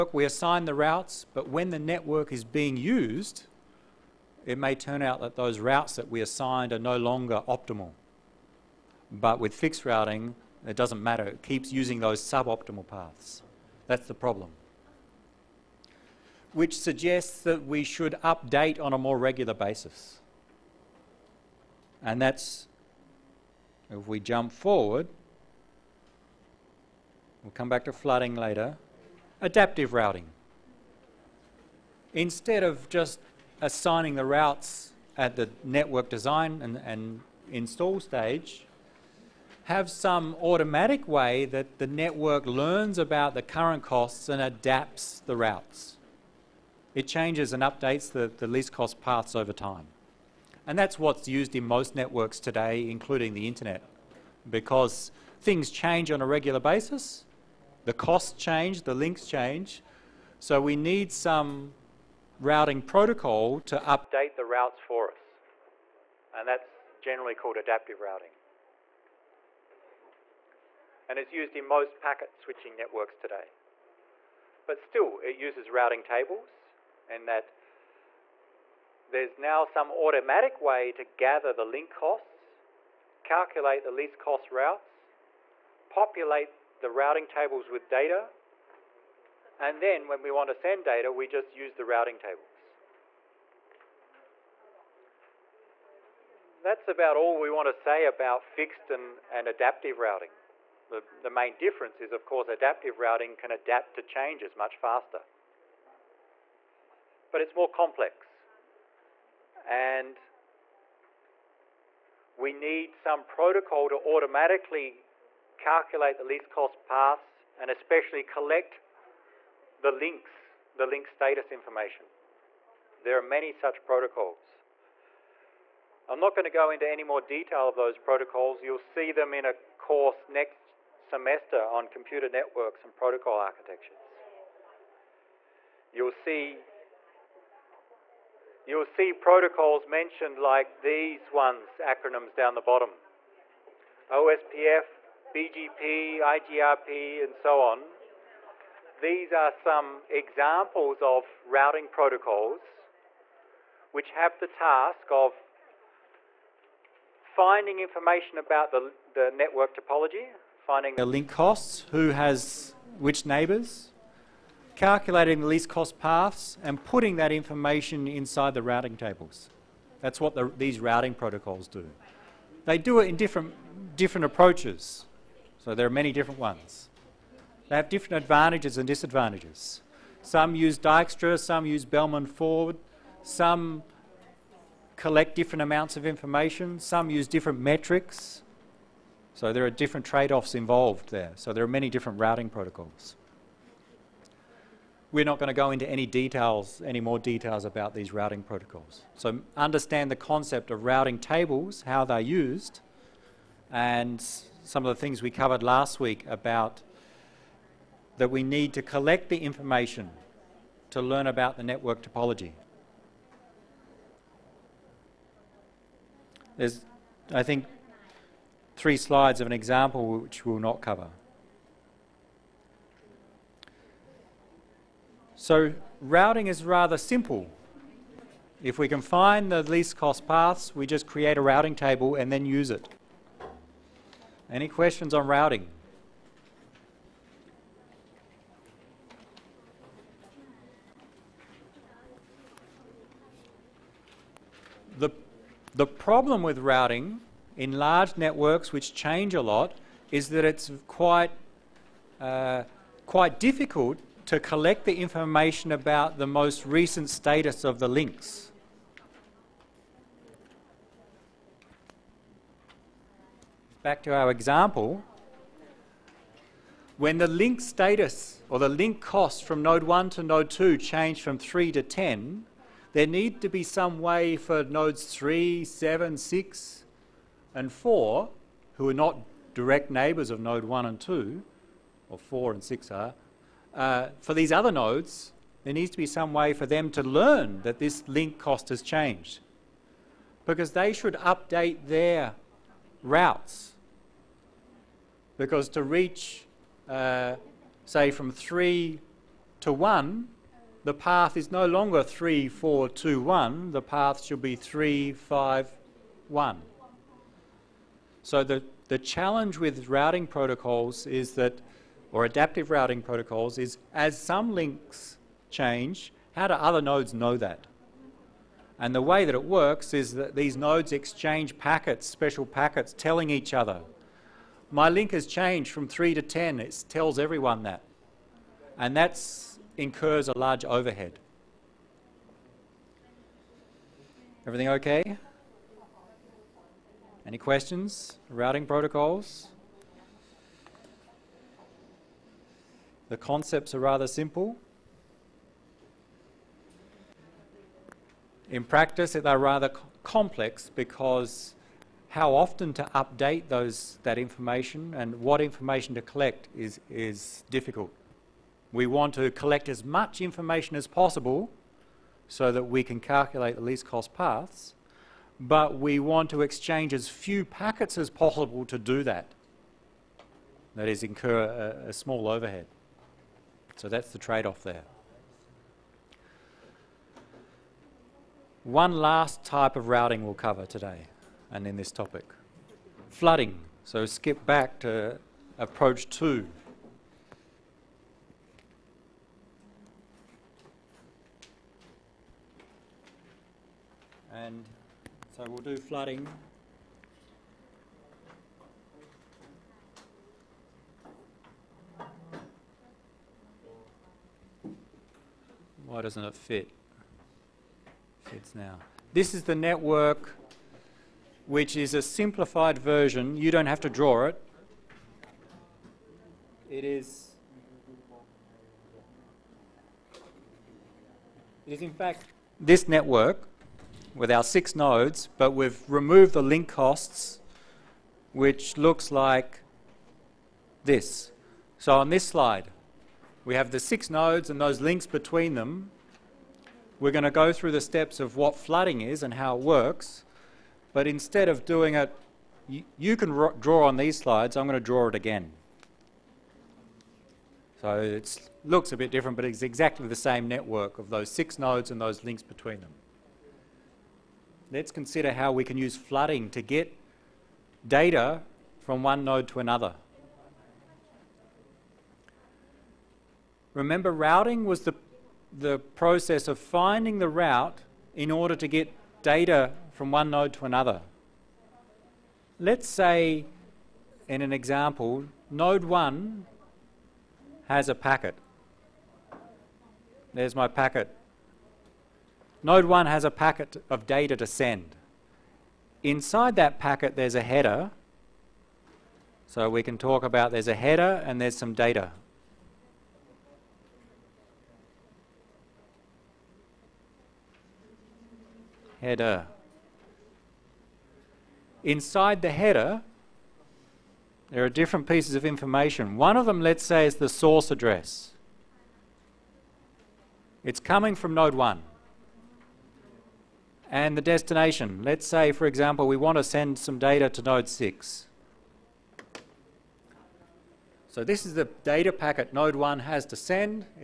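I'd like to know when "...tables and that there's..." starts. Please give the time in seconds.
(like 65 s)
76 s.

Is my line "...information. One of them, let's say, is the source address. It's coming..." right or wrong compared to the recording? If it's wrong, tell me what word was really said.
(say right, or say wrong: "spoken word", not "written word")
right.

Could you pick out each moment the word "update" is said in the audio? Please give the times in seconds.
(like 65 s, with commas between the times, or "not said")
18 s, 47 s, 63 s, 291 s, 352 s.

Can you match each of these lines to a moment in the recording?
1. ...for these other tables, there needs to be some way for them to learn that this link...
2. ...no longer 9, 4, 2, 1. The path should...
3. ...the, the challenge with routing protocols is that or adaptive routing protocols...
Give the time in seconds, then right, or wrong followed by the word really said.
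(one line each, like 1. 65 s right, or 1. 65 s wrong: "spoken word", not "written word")
1. 284 s wrong: "nodes", not "tables"
2. 301 s wrong: "3", not "9"
3. 308 s right.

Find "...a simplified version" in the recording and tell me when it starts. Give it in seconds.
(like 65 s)
411 s.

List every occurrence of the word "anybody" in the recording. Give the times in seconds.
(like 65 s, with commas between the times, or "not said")
not said.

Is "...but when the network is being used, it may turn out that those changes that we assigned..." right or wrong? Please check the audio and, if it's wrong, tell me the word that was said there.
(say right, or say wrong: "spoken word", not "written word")
wrong: "routes", not "changes".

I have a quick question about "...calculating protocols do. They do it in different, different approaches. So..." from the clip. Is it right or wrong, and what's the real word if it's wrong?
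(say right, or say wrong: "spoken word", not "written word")
wrong: "routing", not "calculating".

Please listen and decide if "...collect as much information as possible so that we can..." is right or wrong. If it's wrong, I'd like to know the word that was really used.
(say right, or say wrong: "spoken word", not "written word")
right.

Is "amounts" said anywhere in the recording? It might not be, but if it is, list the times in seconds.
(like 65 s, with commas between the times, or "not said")
185 s.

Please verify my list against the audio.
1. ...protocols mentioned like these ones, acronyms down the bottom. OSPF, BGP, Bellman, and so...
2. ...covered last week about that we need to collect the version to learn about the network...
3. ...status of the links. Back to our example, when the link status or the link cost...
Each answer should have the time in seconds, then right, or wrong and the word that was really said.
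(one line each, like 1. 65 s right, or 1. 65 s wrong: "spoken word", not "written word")
1. 139 s wrong: "IGRP", not "Bellman"
2. 205 s wrong: "information", not "version"
3. 257 s right.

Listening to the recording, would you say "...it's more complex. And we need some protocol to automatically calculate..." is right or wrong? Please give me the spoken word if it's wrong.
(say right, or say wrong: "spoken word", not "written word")
right.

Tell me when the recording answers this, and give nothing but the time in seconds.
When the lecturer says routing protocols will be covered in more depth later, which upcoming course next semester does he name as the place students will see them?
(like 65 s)
131 s.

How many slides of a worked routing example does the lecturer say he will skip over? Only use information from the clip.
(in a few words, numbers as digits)
3.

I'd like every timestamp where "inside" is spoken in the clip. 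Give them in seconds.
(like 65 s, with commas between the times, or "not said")
168 s, 486 s, 501 s.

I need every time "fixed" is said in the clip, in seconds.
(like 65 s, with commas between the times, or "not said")
9 s, 98 s.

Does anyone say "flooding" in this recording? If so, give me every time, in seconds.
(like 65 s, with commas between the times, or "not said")
27 s, 383 s, 395 s, 438 s, 455 s.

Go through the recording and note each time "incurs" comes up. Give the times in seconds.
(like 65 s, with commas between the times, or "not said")
329 s, 371 s.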